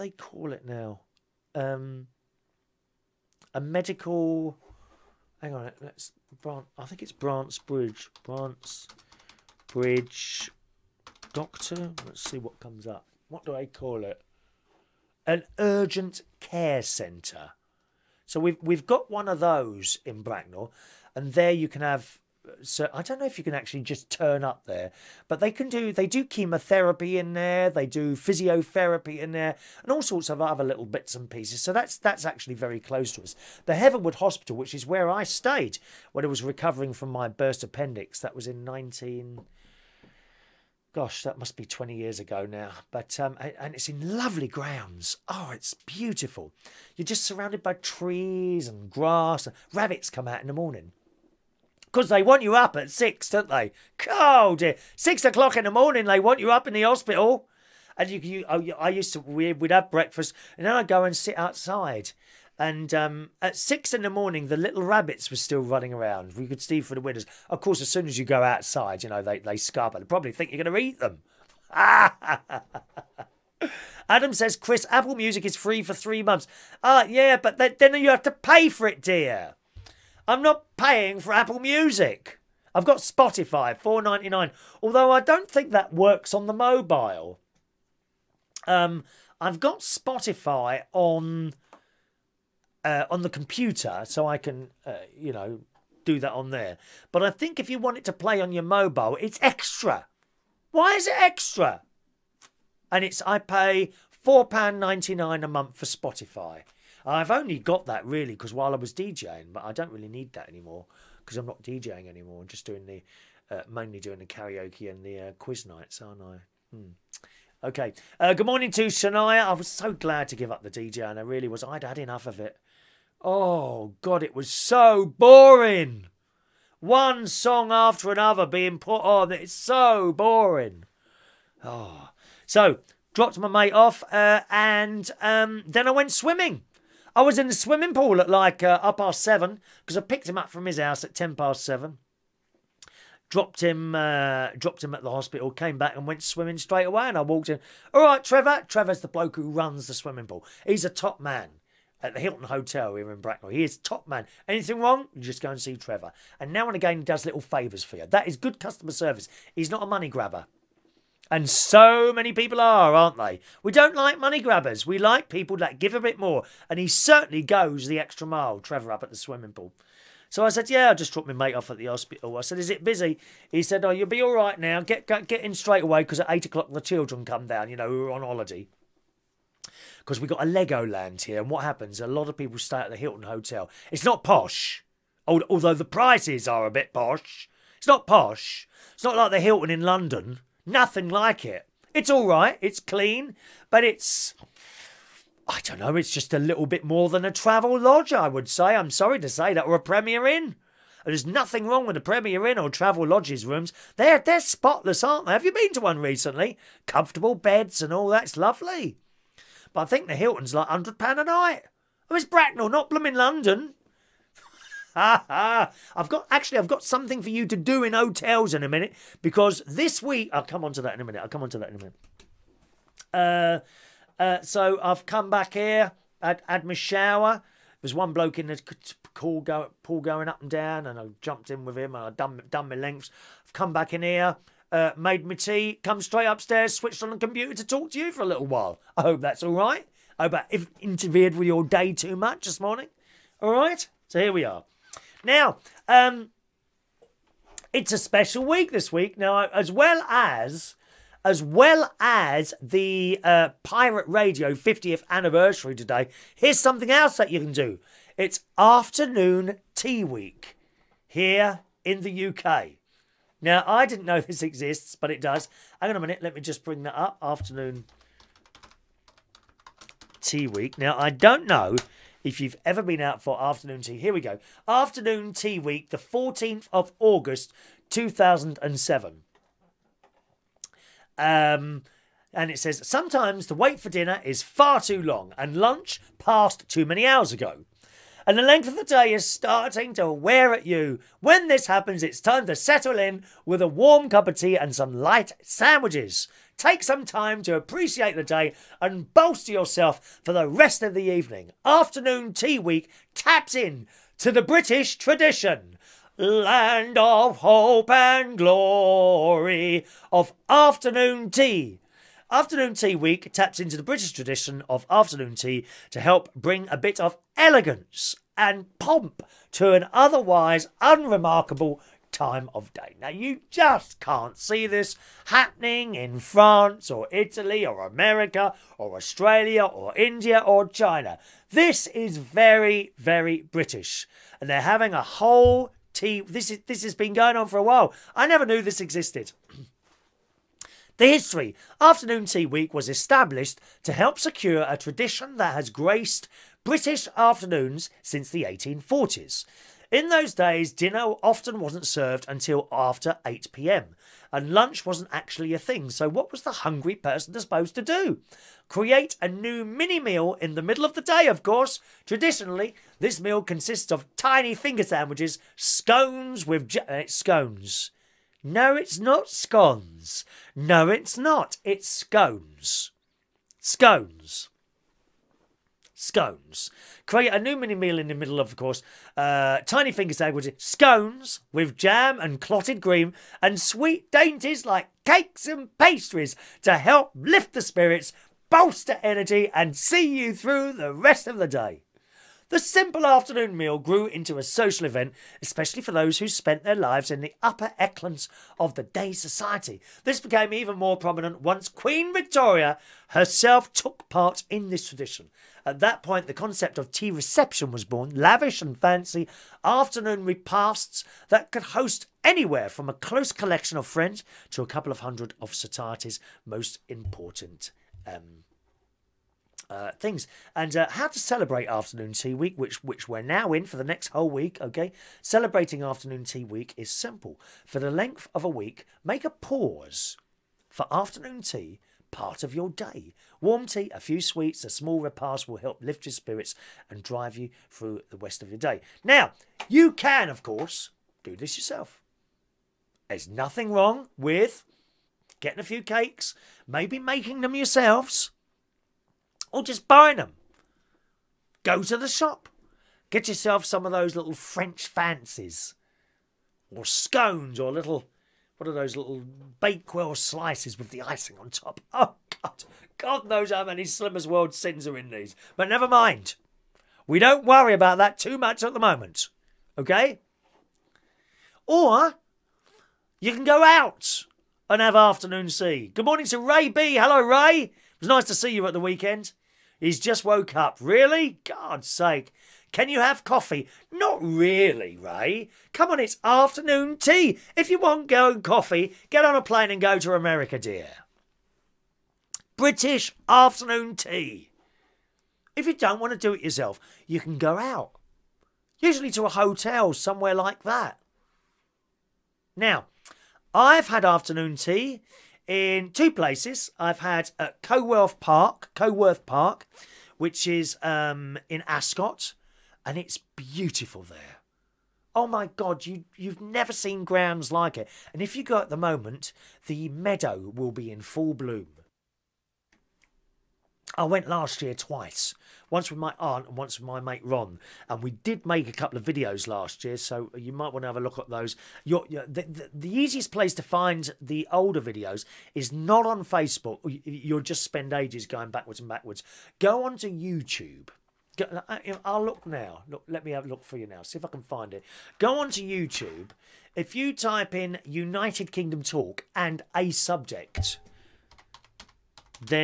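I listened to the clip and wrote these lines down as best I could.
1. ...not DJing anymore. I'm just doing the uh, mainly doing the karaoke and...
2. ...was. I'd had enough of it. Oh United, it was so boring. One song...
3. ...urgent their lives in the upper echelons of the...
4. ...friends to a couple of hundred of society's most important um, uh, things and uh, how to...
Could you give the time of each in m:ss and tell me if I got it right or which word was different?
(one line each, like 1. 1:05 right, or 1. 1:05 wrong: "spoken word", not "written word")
1. 1:51 right
2. 2:01 wrong: "God", not "United"
3. 6:36 wrong: "spent", not "urgent"
4. 6:53 right.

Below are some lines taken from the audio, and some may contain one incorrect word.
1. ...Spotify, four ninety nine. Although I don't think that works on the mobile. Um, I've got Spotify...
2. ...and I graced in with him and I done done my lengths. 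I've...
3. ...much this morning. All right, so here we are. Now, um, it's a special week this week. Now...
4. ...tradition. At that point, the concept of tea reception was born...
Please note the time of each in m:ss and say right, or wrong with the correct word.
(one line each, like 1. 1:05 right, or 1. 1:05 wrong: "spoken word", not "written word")
1. 1:22 right
2. 3:50 wrong: "jumped", not "graced"
3. 4:02 right
4. 6:44 right.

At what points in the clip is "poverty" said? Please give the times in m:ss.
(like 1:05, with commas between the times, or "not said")
not said.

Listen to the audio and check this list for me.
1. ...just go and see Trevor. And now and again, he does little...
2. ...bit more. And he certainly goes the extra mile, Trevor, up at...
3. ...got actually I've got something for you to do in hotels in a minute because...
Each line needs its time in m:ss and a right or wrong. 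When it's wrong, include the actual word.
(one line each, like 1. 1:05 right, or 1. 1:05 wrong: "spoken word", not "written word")
1. 2:35 right
2. 2:45 right
3. 3:36 right.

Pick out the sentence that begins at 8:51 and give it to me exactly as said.
the, the, the easiest place to find the older videos is not on Facebook.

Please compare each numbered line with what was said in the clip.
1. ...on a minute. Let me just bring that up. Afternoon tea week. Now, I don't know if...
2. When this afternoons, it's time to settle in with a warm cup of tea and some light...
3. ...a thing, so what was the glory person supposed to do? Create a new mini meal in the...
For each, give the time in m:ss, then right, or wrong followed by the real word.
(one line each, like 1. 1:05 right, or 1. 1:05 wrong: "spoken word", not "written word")
1. 4:25 right
2. 4:51 wrong: "happens", not "afternoons"
3. 5:55 wrong: "hungry", not "glory".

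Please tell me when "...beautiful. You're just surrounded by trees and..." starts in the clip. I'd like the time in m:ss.
0:45.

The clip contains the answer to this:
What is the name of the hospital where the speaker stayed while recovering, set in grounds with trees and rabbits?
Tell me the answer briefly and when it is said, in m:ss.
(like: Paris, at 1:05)
Heatherwood Hospital, at 0:33.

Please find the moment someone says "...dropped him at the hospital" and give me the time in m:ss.
2:24.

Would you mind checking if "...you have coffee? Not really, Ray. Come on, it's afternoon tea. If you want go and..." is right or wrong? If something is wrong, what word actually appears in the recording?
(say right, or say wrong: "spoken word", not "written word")
right.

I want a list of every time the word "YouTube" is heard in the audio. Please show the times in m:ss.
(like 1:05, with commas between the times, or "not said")
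9:00, 9:05.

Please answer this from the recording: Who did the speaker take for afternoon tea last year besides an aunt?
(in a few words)
Ron.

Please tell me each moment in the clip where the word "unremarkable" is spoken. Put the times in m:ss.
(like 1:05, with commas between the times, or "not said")
5:20.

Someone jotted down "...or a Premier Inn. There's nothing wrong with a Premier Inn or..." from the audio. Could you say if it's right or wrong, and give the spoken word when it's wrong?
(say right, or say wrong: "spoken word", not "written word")
right.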